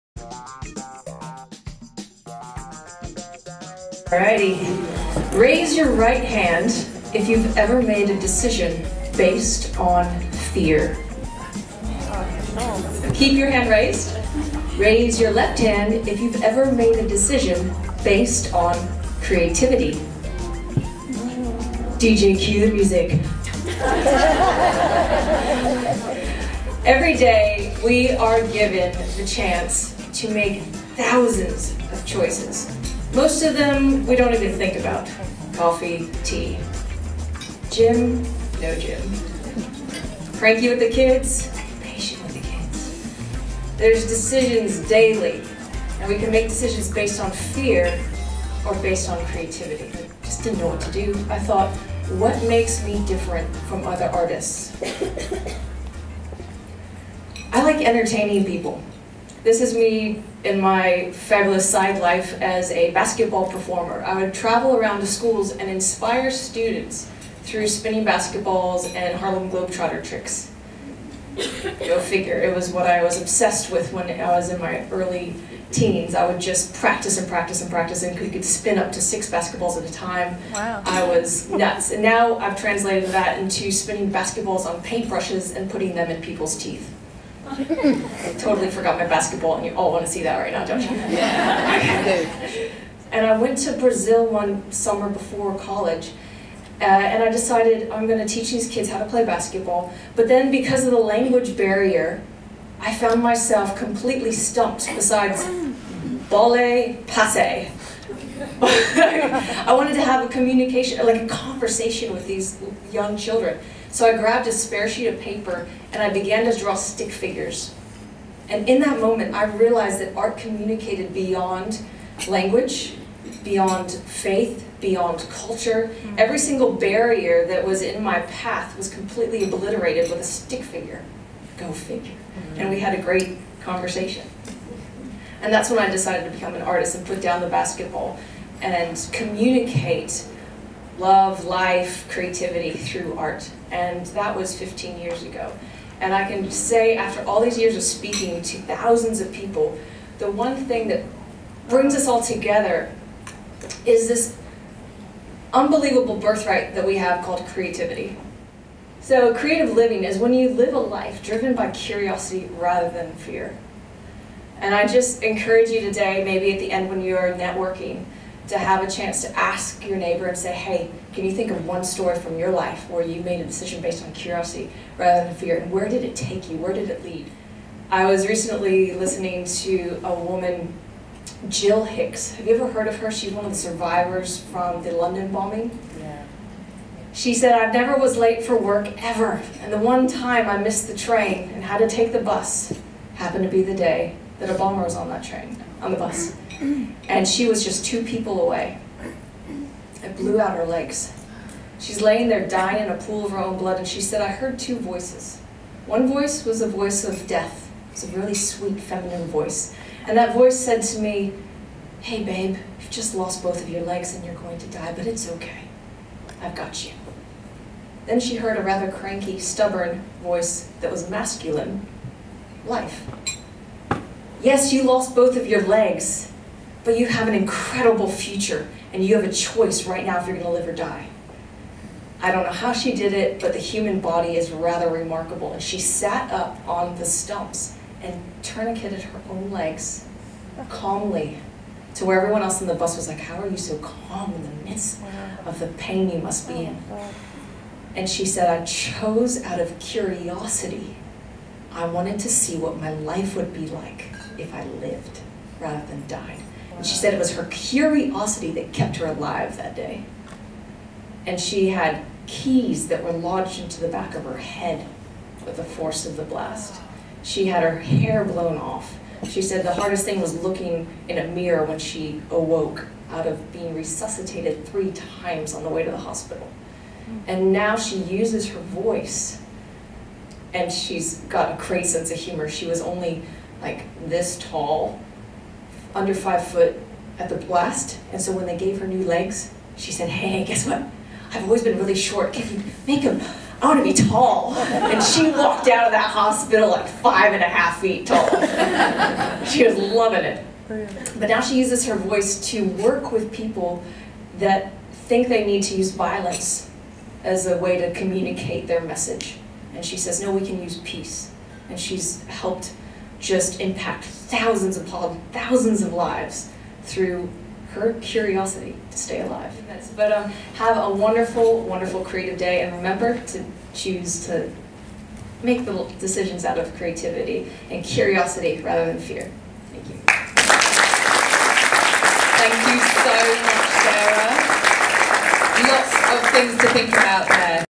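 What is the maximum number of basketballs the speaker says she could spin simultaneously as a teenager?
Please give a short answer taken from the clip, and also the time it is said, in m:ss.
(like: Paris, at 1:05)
6, at 1:19.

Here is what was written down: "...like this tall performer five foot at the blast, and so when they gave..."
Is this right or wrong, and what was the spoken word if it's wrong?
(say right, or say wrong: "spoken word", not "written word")
wrong: "under", not "performer".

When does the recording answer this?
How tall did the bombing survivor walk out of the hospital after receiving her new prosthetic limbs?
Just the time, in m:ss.
4:56.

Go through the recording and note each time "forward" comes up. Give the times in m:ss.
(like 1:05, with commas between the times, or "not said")
not said.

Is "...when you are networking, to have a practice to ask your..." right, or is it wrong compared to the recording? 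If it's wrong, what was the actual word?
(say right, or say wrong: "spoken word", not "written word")
wrong: "chance", not "practice".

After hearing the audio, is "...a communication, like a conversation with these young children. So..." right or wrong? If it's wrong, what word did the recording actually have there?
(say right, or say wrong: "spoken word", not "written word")
right.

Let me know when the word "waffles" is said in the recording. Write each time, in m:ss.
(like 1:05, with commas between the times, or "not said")
not said.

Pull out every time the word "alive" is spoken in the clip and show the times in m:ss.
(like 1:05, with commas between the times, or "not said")
4:19, 5:19.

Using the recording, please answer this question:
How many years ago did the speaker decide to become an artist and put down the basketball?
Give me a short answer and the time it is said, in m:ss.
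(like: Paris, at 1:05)
15, at 2:24.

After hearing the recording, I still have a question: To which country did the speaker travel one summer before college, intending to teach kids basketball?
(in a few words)
Brazil.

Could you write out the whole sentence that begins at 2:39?
So creative living is when you live a life driven by curiosity rather than fear.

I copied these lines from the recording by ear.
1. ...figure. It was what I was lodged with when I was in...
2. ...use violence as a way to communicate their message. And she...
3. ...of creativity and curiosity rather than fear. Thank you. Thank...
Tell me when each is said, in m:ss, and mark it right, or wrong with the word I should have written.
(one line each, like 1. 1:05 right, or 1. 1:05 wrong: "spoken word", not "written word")
1. 1:11 wrong: "obsessed", not "lodged"
2. 5:05 right
3. 5:26 right.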